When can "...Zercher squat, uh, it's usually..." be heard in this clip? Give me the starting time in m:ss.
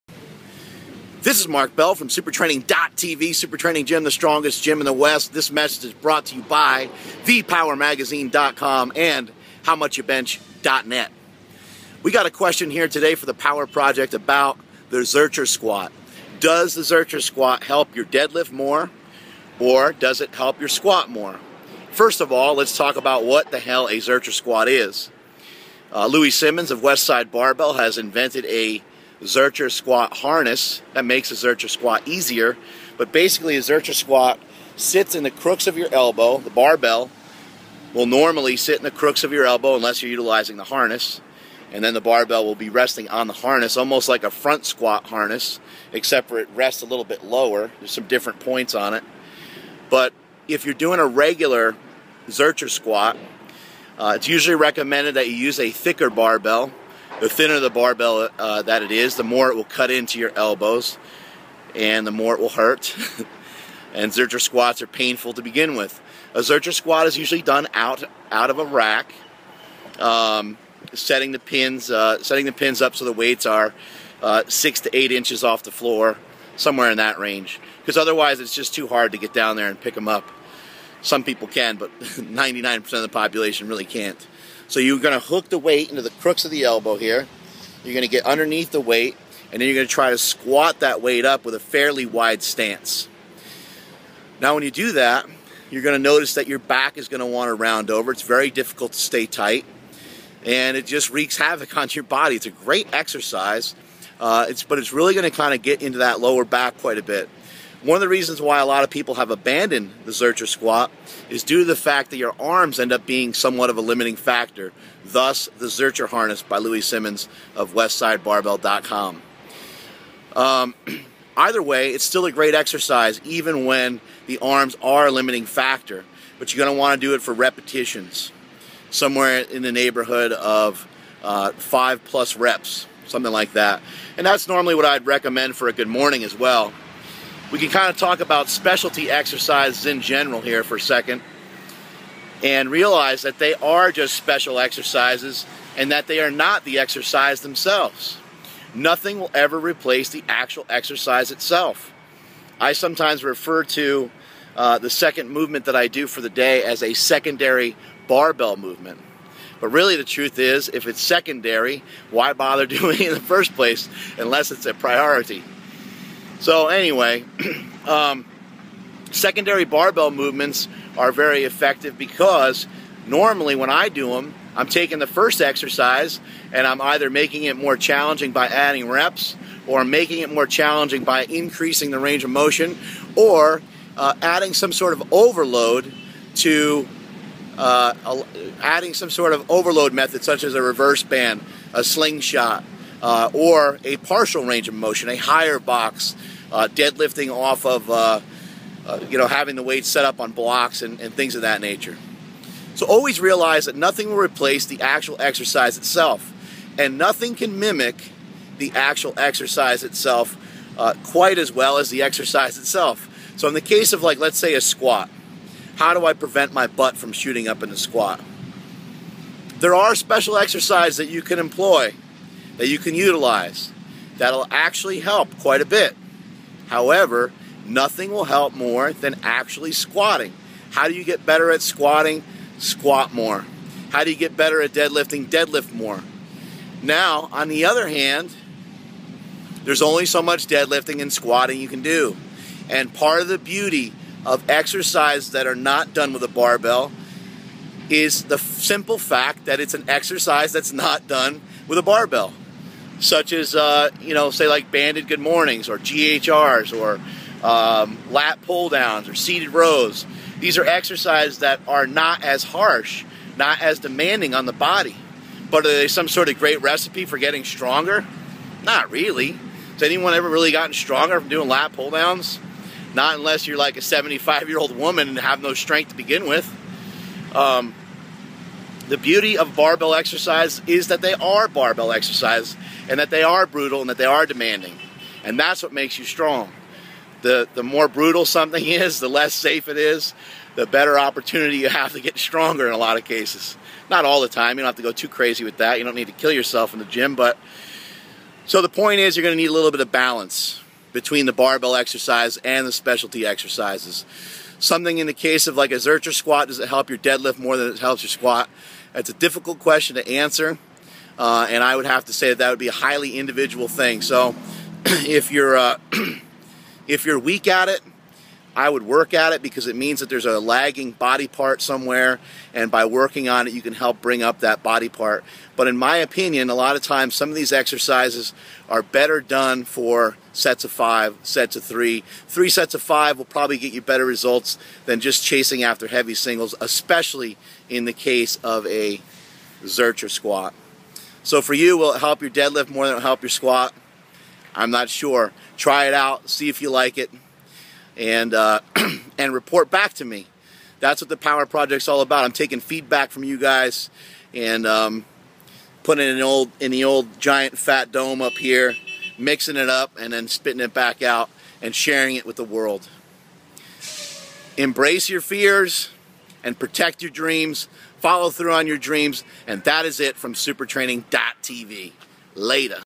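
0:52.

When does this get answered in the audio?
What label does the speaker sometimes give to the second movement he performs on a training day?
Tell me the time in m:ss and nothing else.
2:36.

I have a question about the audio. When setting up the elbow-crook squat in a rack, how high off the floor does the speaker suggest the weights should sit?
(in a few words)
6 to 8 inches.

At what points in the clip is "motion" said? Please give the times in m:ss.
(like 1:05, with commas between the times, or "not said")
3:02, 3:14.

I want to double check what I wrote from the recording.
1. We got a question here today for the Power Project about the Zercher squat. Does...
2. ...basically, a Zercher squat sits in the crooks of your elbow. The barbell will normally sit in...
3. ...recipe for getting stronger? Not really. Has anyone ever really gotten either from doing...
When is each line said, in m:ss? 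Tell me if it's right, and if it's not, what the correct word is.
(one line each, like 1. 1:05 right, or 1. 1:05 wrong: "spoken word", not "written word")
1. 0:12 right
2. 0:33 right
3. 4:26 wrong: "stronger", not "either".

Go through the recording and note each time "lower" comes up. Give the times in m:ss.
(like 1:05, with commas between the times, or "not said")
0:47, 1:46.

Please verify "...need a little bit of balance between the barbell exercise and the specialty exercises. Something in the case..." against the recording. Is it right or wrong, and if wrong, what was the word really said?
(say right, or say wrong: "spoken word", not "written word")
right.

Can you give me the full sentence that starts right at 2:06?
But you're going to want to do it for repetitions, somewhere in the neighborhood of uh, five plus reps, something like that.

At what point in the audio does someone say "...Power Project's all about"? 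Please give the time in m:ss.
5:51.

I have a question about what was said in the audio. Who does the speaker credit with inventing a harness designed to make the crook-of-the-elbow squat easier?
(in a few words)
Louie Simmons.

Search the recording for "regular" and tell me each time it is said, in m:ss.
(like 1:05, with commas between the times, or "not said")
0:51.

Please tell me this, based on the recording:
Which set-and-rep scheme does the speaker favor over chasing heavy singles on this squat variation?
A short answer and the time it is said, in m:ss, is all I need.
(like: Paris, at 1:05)
3 sets of 5, at 5:32.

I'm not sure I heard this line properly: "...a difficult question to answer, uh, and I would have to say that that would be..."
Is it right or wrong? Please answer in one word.
right.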